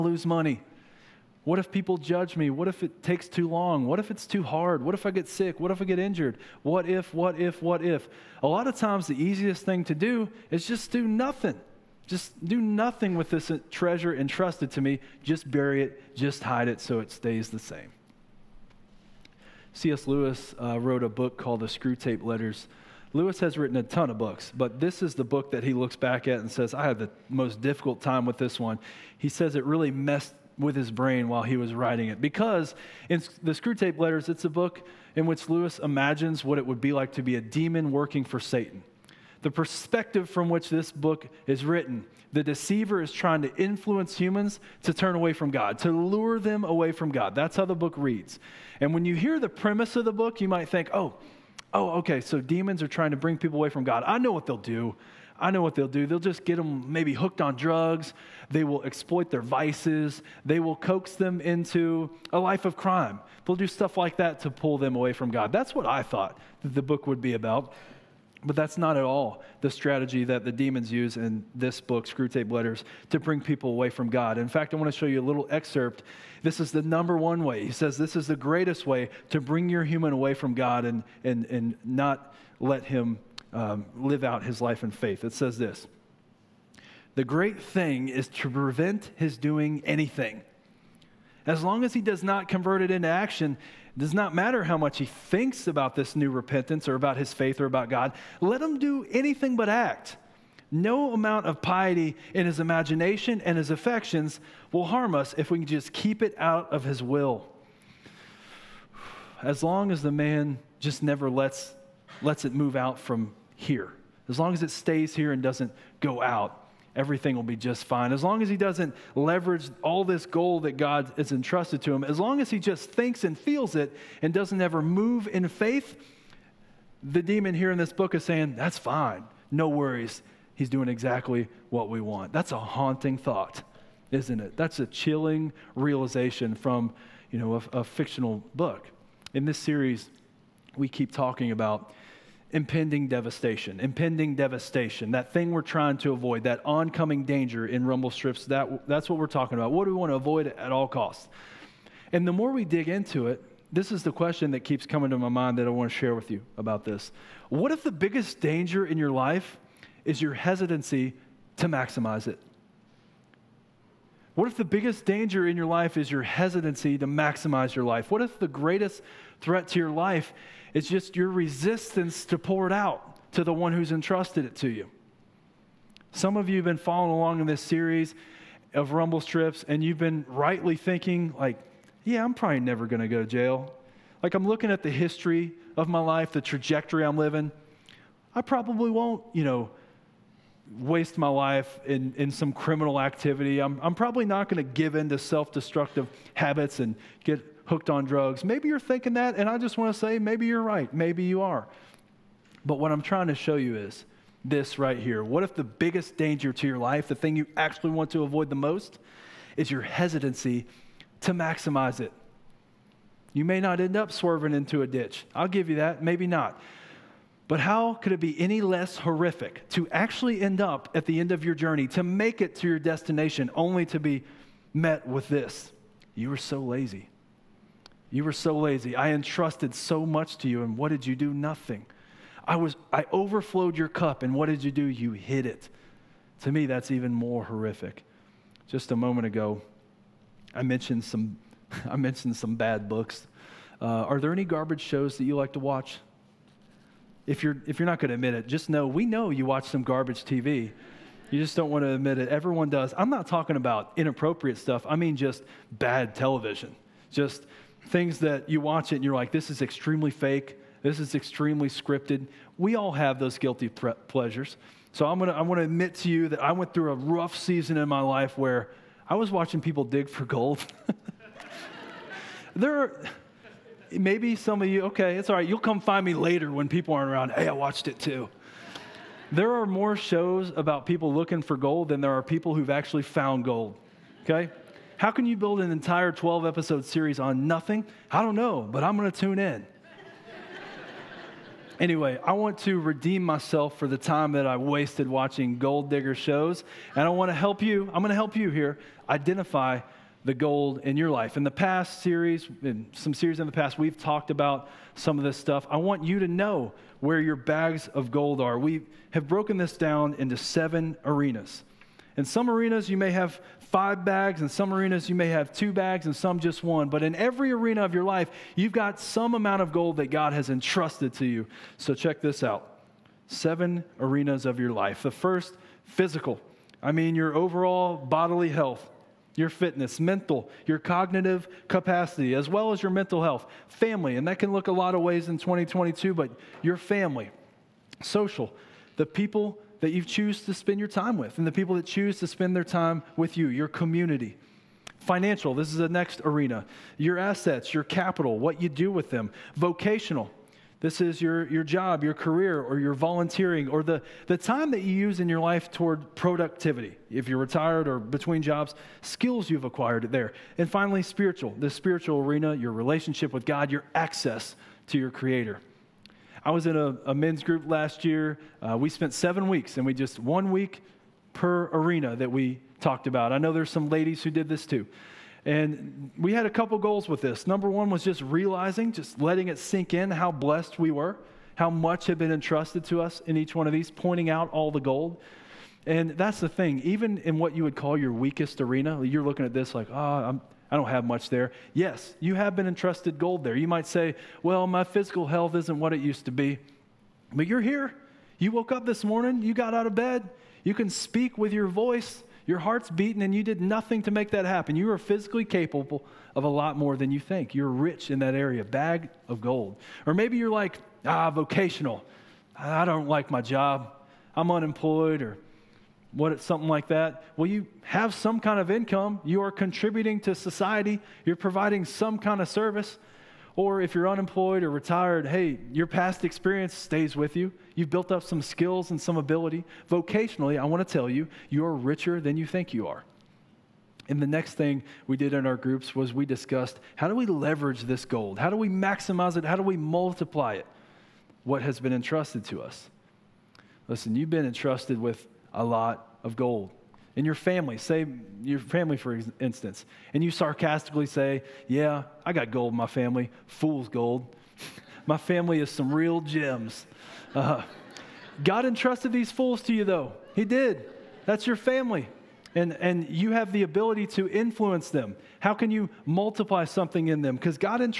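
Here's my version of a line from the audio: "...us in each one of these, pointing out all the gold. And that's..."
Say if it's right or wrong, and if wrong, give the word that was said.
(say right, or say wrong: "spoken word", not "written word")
right.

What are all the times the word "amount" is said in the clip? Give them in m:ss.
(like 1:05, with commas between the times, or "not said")
1:41, 5:19.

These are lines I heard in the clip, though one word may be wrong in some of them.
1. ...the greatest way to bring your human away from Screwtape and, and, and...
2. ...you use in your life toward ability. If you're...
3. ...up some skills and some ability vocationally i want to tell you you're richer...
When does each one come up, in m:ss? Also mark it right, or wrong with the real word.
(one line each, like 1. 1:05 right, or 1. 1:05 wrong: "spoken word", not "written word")
1. 1:18 wrong: "God", not "Screwtape"
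2. 5:54 wrong: "productivity", not "ability"
3. 7:08 right.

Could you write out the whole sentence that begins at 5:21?
So check this out seven arenas of your life.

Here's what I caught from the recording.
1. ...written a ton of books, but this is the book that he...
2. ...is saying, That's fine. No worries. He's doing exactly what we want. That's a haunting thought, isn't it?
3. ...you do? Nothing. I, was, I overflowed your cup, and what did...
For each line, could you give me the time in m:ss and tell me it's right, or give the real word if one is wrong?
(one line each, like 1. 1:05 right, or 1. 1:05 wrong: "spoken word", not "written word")
1. 0:23 right
2. 2:08 right
3. 3:51 right.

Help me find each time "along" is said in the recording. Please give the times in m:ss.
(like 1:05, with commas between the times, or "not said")
2:57.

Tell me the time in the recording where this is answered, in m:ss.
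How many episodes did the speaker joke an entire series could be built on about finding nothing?
4:46.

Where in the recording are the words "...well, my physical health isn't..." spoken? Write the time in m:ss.
6:34.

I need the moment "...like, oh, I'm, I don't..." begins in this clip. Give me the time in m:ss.
6:29.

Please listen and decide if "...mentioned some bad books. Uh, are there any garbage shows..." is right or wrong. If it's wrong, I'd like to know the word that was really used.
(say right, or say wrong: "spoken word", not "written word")
right.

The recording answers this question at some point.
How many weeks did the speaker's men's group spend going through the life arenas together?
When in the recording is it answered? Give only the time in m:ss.
6:09.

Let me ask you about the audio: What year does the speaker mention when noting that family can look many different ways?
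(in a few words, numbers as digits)
2022.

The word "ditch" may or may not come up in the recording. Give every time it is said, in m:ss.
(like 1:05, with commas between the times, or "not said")
3:34.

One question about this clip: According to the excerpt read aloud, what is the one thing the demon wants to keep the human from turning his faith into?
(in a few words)
action.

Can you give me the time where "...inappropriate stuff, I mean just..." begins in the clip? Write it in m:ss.
4:13.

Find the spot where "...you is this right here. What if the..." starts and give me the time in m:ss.
3:23.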